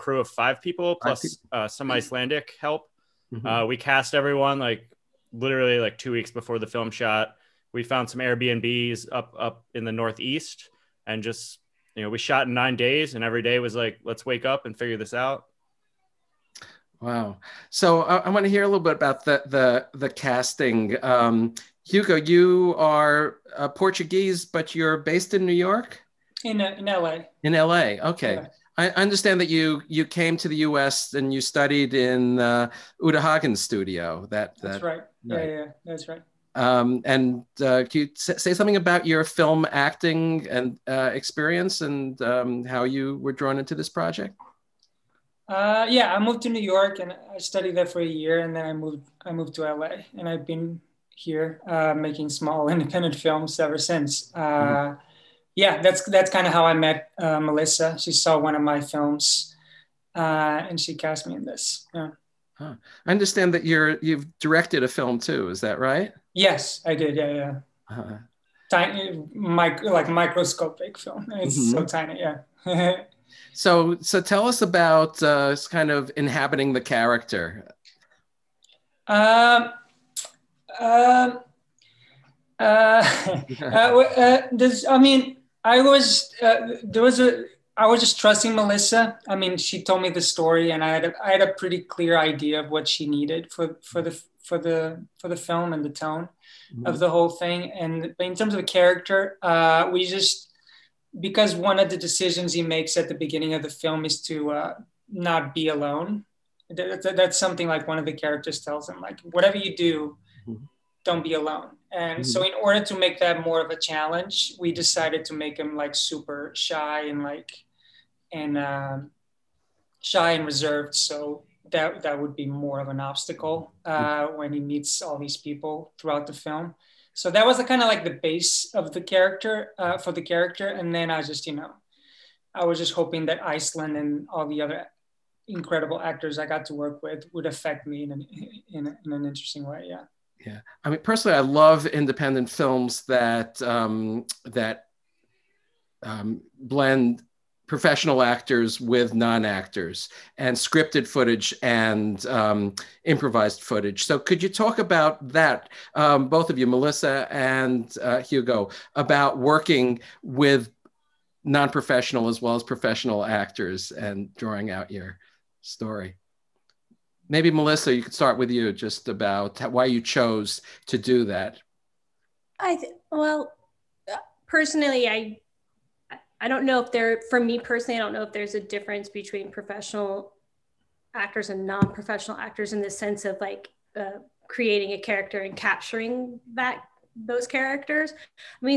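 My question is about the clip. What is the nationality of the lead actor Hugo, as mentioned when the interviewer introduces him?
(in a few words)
Portuguese.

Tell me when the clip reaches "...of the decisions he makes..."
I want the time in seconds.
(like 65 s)
101 s.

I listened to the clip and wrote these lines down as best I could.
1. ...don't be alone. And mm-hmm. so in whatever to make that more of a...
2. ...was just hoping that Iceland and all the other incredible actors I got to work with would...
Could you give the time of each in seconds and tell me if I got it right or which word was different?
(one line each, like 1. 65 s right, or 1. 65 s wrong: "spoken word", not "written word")
1. 111 s wrong: "order", not "whatever"
2. 132 s right.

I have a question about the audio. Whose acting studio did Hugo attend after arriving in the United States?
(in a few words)
Uta Hagen.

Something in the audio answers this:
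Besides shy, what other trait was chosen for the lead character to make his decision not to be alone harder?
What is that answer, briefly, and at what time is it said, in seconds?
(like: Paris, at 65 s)
Reserved, at 120 s.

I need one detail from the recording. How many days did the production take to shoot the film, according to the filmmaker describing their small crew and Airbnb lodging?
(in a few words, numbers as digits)
9.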